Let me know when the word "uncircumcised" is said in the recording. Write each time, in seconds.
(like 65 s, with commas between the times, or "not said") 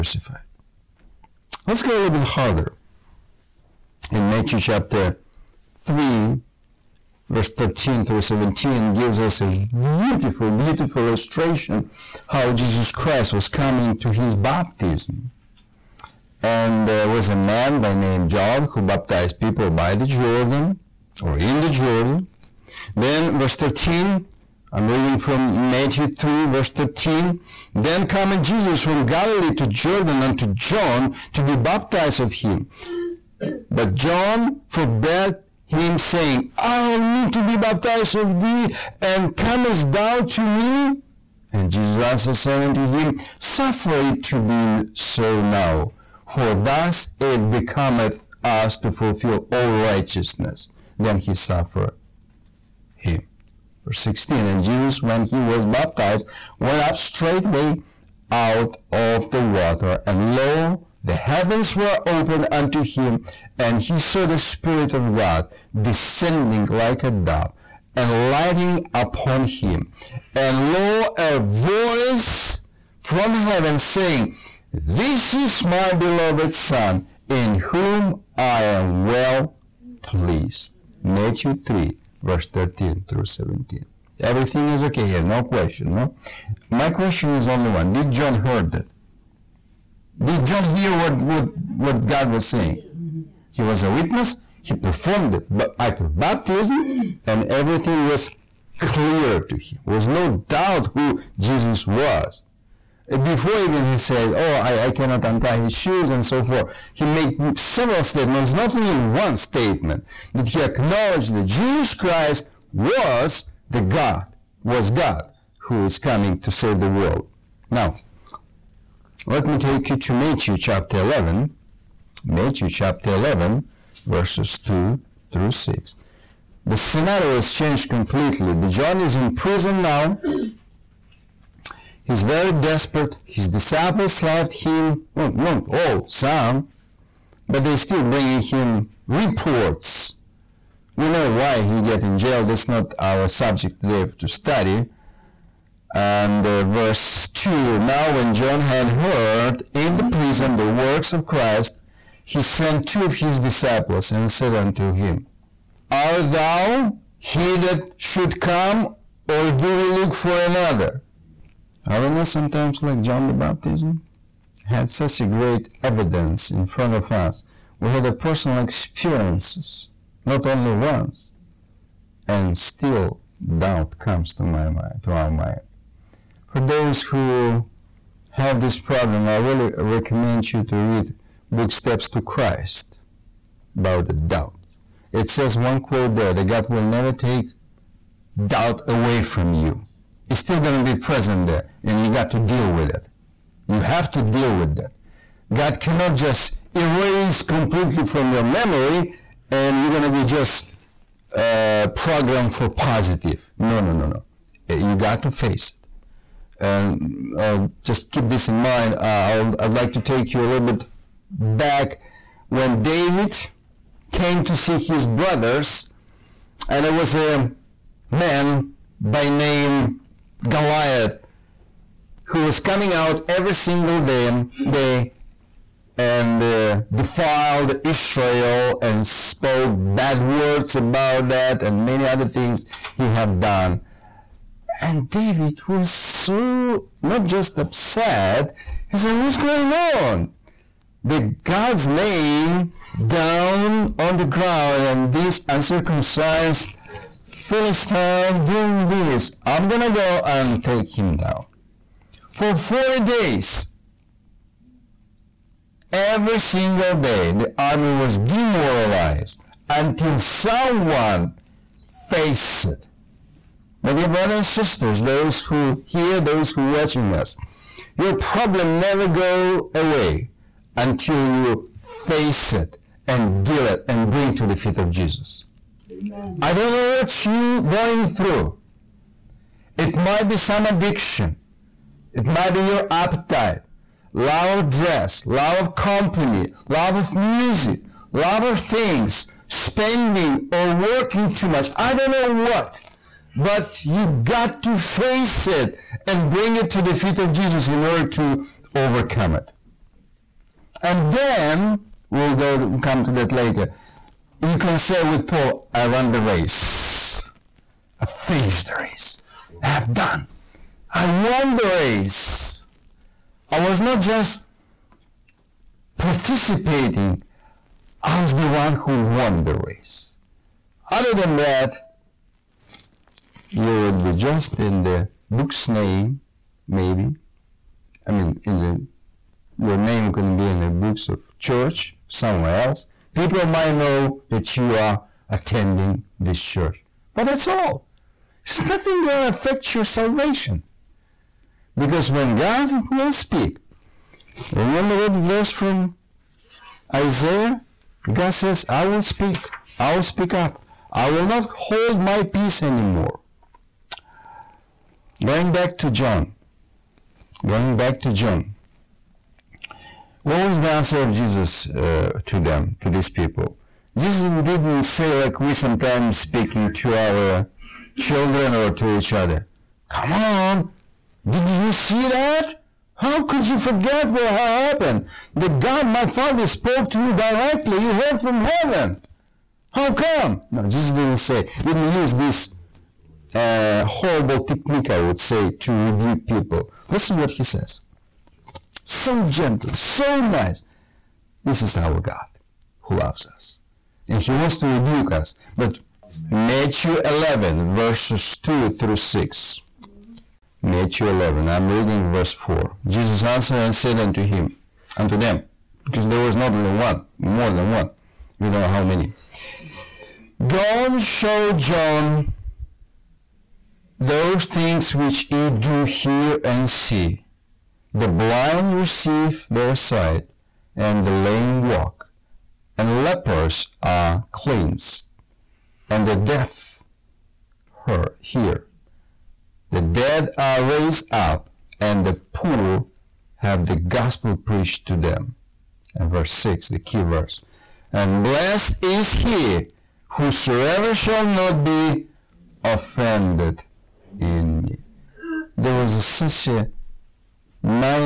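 245 s.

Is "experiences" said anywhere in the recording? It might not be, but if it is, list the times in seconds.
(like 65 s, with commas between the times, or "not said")
168 s.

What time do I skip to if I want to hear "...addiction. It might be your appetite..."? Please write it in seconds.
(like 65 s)
280 s.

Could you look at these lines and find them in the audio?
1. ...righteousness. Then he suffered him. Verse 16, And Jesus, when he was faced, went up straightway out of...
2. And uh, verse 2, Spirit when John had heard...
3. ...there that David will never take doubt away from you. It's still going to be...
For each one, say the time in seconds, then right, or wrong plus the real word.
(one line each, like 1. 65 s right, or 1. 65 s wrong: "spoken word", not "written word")
1. 49 s wrong: "baptized", not "faced"
2. 145 s wrong: "Now", not "Spirit"
3. 186 s wrong: "God", not "David".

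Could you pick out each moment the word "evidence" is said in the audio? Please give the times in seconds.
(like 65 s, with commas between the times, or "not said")
165 s.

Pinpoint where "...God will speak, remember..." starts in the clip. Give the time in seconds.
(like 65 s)
342 s.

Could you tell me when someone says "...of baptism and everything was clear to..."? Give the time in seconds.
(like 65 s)
95 s.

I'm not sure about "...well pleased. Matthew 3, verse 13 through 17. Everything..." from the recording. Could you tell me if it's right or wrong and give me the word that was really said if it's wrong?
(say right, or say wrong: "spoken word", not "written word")
right.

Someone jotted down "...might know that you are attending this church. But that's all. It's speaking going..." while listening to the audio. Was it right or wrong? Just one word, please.
wrong.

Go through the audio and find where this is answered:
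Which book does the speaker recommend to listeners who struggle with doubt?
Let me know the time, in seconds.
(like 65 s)
181 s.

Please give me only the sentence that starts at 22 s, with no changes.
Then verse 13, I'm reading from Matthew 3 verse 13.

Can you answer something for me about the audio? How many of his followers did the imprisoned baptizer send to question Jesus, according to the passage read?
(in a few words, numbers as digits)
2.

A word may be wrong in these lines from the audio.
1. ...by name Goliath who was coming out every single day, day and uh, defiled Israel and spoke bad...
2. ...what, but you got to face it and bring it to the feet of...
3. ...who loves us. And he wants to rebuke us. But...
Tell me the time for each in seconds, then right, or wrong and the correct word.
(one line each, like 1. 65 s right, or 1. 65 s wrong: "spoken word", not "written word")
1. 218 s right
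2. 292 s right
3. 392 s right.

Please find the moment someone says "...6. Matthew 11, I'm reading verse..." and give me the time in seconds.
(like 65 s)
398 s.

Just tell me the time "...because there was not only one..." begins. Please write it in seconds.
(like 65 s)
405 s.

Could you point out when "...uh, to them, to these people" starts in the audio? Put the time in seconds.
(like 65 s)
361 s.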